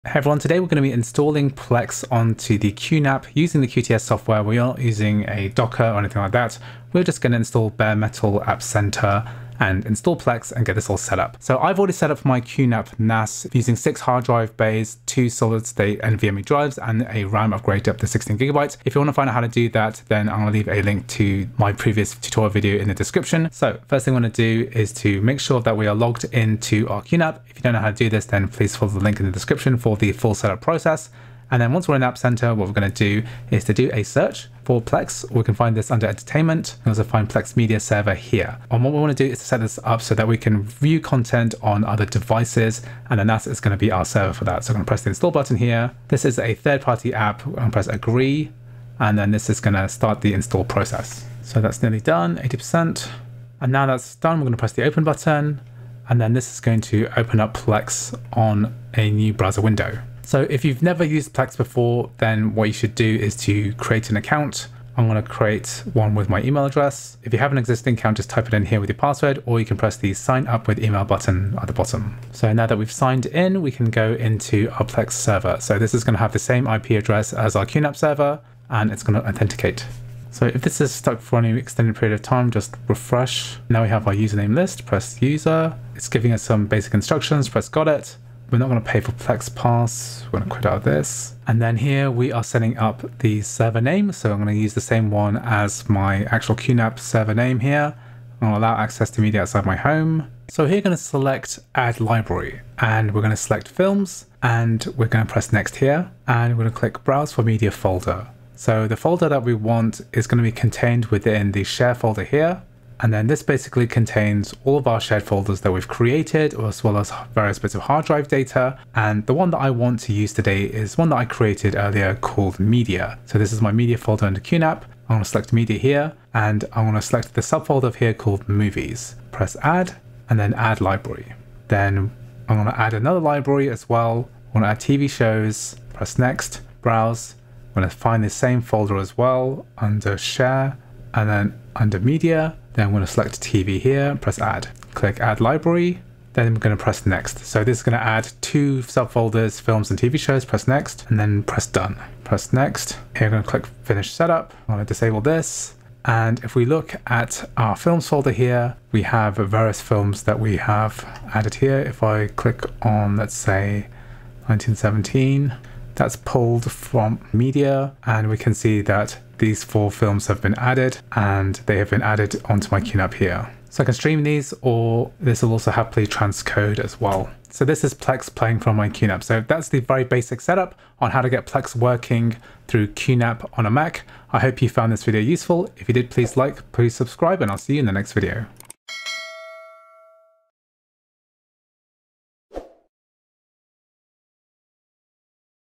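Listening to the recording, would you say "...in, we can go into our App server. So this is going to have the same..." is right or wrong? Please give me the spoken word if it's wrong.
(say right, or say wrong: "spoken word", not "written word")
wrong: "Plex", not "App".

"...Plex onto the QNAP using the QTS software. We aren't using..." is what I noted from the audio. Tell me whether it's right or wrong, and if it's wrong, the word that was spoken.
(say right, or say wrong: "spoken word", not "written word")
right.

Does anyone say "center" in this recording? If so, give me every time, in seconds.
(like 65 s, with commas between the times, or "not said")
8 s, 32 s.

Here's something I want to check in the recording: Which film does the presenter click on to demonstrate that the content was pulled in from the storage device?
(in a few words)
1917.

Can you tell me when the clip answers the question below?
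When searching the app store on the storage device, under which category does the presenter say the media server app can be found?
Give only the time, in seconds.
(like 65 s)
36 s.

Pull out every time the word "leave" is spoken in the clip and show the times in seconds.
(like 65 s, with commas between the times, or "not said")
20 s.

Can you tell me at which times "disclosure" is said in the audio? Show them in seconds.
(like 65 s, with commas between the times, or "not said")
not said.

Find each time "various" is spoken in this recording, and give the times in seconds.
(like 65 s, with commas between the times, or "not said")
117 s, 159 s.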